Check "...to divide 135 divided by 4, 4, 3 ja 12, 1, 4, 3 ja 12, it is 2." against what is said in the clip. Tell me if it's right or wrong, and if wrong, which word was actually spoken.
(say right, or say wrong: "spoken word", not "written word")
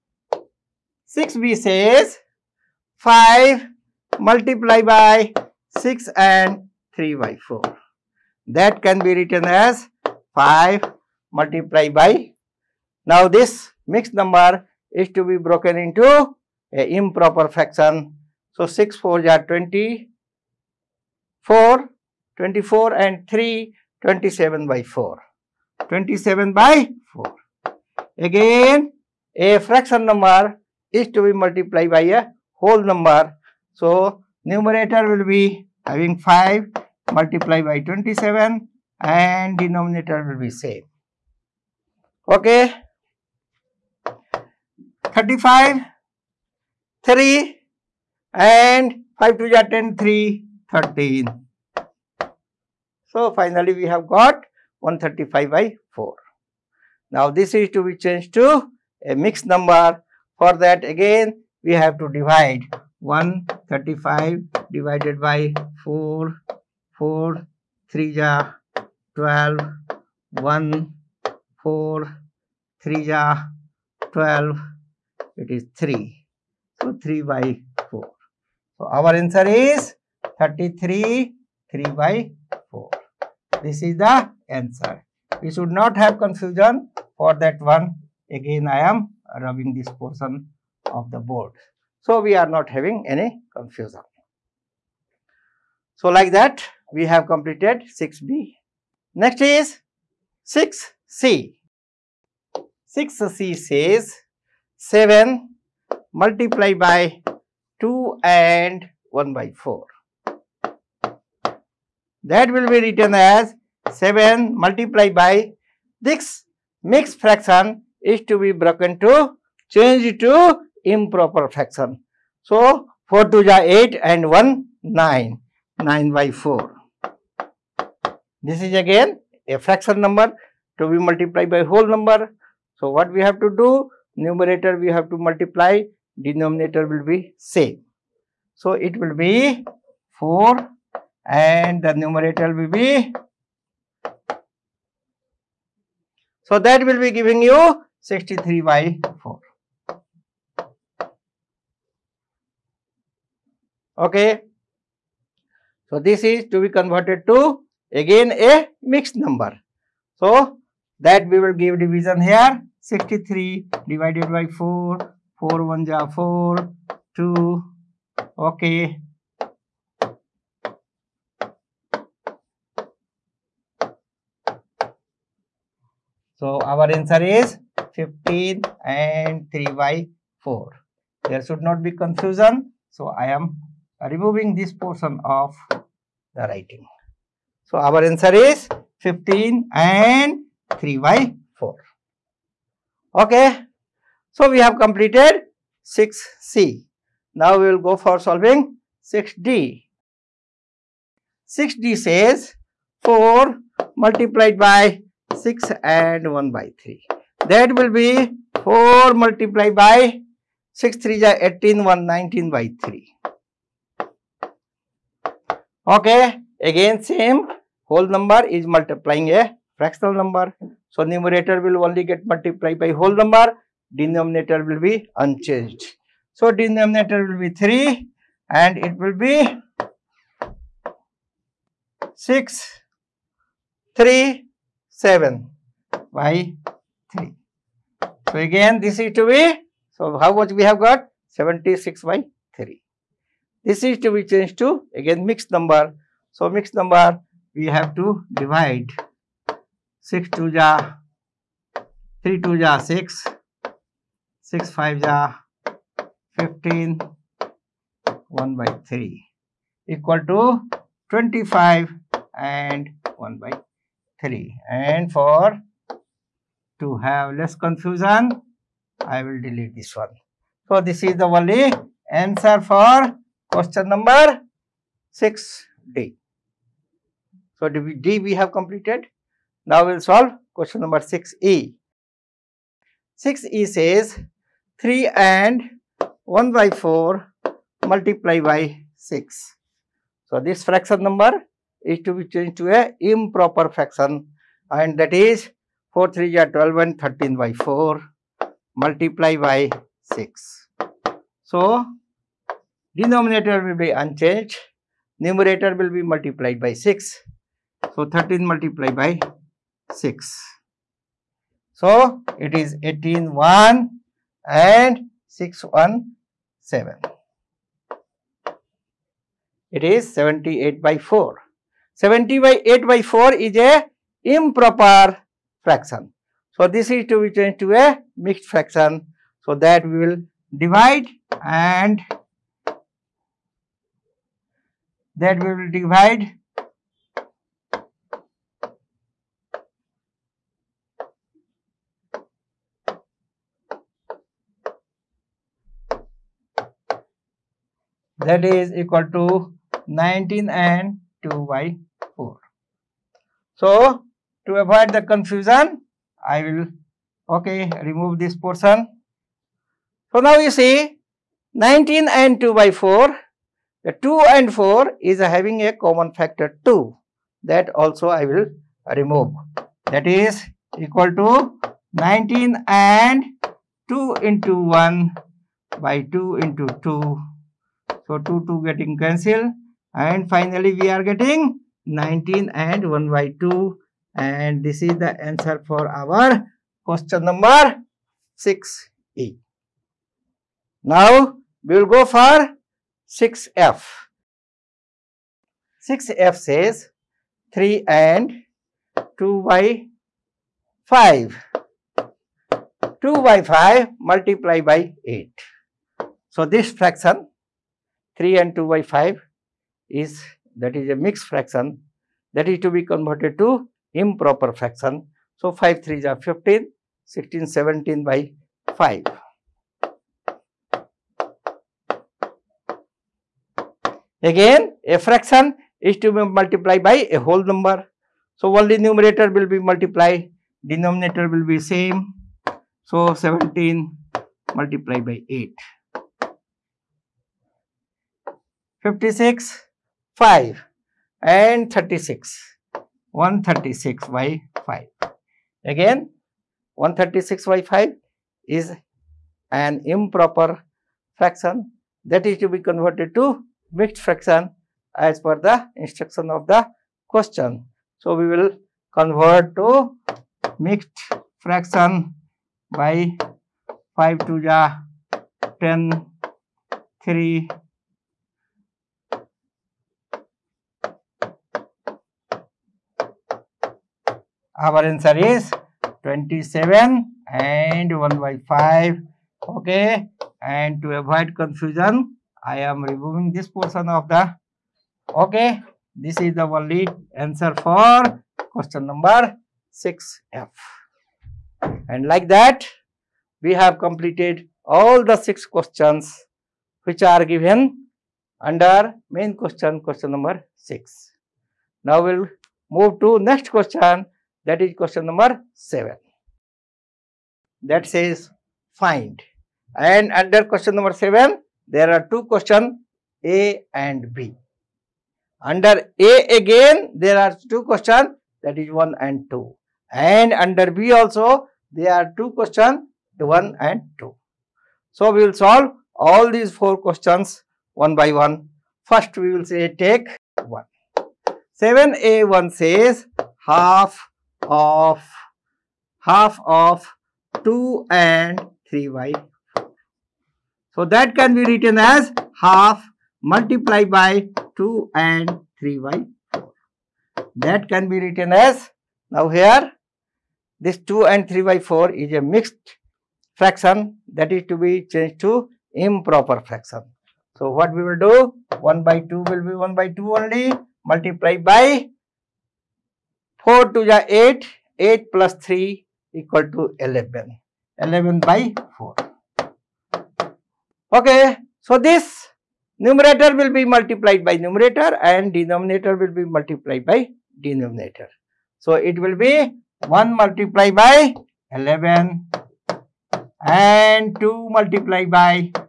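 wrong: "3", not "2".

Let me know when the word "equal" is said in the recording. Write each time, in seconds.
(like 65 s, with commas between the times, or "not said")
259 s, 348 s, 370 s, 566 s.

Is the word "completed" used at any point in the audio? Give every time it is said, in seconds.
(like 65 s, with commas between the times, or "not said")
97 s, 194 s, 278 s, 493 s.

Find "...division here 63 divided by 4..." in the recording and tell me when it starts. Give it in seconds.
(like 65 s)
161 s.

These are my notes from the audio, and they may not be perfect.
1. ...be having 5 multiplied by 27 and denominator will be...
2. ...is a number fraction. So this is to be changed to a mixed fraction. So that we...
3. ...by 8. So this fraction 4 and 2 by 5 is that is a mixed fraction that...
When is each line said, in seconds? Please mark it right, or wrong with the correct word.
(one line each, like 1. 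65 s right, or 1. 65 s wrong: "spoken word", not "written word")
1. 35 s right
2. 323 s wrong: "improper", not "number"
3. 404 s wrong: "3", not "4".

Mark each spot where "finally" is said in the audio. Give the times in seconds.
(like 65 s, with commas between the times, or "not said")
53 s, 380 s.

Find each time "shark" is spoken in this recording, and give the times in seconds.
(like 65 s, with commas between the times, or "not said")
not said.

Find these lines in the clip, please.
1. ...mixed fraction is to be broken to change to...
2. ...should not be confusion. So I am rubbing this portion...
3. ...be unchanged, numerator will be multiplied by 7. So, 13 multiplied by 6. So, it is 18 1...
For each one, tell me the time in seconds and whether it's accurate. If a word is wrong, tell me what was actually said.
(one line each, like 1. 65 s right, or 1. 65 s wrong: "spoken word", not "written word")
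1. 116 s right
2. 181 s wrong: "removing", not "rubbing"
3. 303 s wrong: "6", not "7".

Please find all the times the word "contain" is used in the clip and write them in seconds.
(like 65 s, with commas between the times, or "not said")
not said.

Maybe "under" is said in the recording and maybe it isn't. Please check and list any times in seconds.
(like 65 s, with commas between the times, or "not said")
498 s, 510 s, 515 s, 520 s.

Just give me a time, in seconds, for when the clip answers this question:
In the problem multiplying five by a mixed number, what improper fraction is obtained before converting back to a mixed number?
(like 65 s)
54 s.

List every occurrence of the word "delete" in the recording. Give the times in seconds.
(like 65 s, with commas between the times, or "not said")
269 s.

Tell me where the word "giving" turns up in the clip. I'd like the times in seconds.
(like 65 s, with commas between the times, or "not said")
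147 s.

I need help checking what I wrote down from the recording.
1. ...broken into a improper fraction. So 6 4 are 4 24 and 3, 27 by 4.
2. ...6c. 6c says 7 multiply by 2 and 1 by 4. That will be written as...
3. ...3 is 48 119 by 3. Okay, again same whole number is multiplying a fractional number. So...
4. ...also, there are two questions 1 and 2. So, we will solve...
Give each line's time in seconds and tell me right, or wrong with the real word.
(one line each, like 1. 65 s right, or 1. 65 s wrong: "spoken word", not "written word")
1. 15 s right
2. 100 s right
3. 210 s wrong: "18", not "48"
4. 520 s right.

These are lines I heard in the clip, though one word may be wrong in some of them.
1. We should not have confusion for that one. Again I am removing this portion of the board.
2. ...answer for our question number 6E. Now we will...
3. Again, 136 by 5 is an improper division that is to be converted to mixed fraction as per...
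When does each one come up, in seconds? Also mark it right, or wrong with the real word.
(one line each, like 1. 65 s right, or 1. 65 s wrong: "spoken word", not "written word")
1. 85 s wrong: "rubbing", not "removing"
2. 385 s right
3. 445 s wrong: "fraction", not "division".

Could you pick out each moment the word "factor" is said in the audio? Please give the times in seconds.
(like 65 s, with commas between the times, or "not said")
366 s.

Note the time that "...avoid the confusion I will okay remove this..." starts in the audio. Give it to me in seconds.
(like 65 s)
354 s.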